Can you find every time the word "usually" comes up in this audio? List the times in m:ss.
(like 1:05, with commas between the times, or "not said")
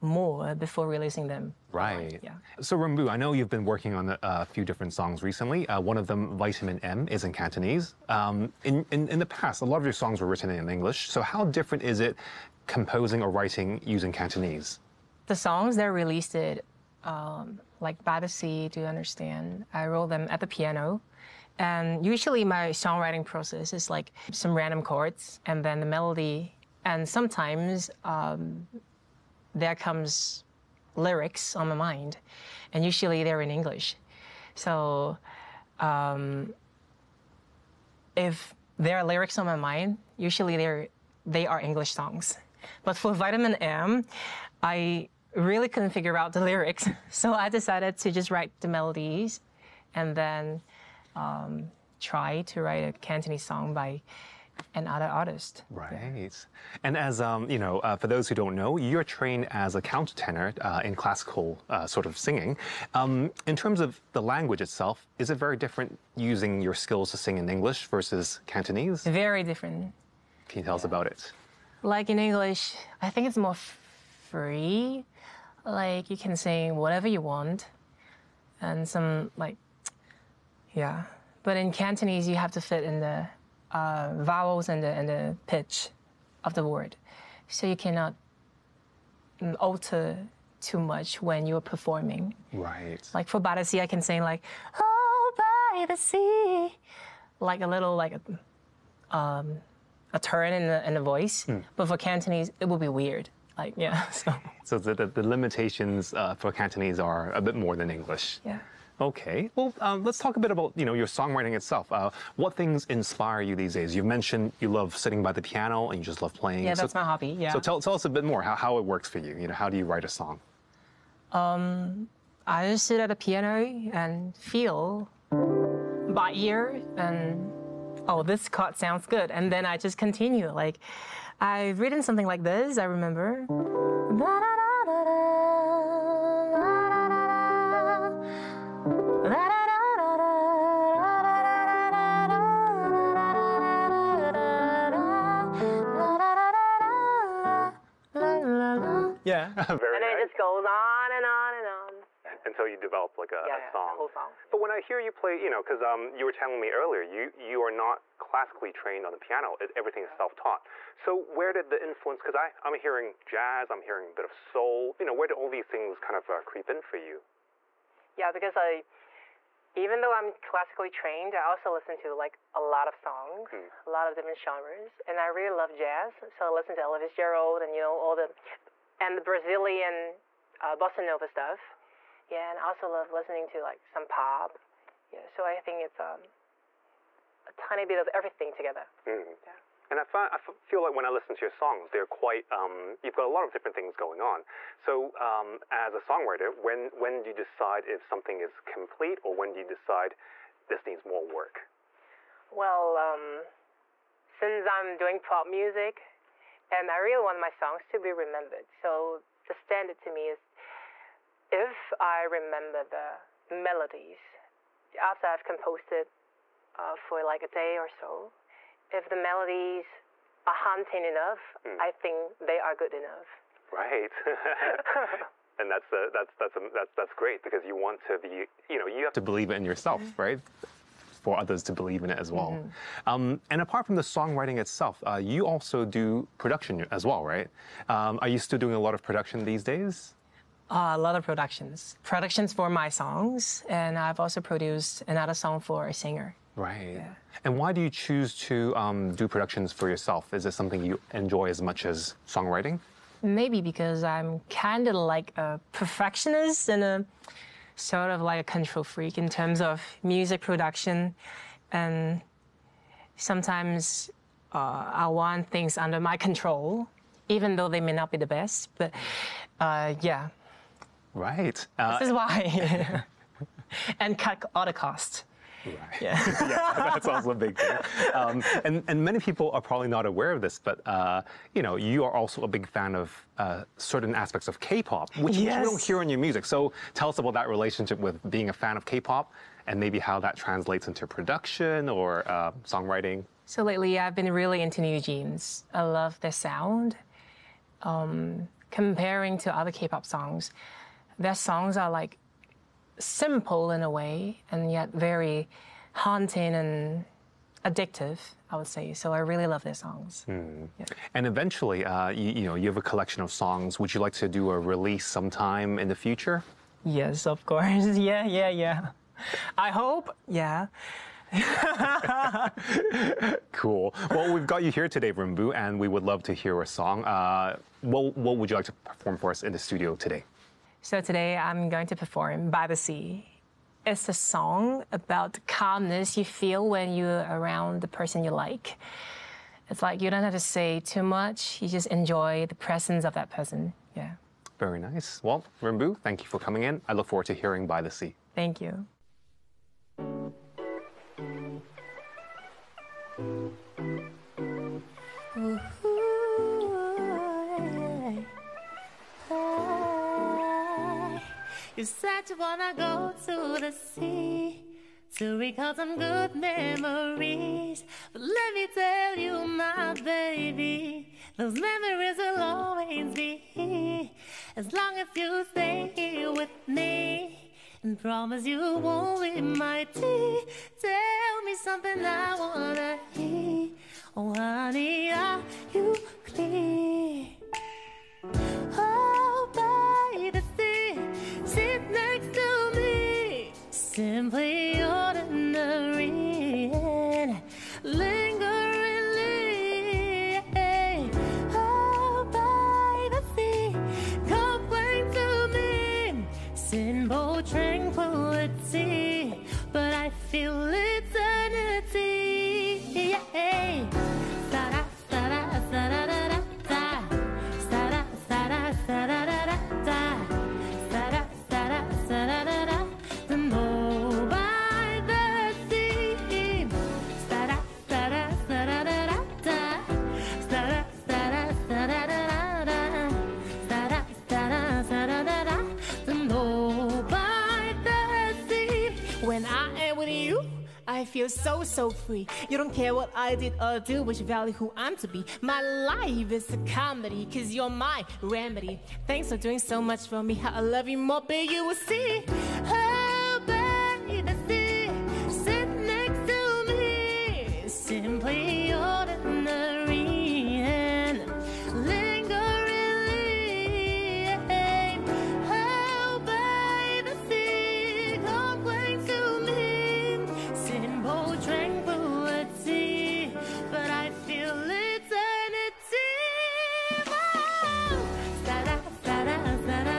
0:22, 0:32, 0:40.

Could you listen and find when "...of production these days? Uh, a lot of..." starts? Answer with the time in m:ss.
3:58.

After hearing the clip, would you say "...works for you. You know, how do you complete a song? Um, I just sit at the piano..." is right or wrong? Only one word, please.
wrong.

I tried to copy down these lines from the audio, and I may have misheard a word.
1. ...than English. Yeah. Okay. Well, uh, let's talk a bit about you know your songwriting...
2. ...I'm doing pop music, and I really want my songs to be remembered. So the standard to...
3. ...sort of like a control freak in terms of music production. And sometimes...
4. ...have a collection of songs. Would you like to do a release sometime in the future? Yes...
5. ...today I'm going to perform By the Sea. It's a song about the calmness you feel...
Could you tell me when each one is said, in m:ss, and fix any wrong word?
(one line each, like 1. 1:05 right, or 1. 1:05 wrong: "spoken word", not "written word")
1. 1:47 right
2. 3:24 right
3. 4:17 right
4. 5:12 right
5. 5:31 right.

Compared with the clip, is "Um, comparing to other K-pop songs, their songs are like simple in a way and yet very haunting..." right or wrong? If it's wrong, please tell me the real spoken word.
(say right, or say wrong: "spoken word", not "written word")
right.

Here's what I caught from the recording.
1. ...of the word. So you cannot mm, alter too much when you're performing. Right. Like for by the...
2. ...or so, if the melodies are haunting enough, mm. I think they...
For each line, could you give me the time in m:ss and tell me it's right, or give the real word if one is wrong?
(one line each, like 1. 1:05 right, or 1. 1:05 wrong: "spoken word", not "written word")
1. 1:26 right
2. 3:37 right.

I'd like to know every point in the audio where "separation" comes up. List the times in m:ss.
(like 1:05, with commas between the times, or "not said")
not said.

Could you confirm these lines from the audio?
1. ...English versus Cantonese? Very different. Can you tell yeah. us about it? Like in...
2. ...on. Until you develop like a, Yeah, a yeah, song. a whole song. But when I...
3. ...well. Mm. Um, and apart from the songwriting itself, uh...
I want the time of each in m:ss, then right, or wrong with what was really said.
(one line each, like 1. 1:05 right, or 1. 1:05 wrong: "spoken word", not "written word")
1. 1:07 right
2. 2:31 right
3. 3:52 right.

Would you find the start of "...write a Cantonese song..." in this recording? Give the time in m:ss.
0:52.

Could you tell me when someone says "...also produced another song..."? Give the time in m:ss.
4:04.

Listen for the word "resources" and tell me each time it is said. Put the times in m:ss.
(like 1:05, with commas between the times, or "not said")
not said.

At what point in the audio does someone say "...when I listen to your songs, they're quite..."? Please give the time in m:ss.
3:10.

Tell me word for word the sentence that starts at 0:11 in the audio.
So how different is it composing or writing using Cantonese?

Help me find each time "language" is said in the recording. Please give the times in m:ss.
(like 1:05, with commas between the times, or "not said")
1:04.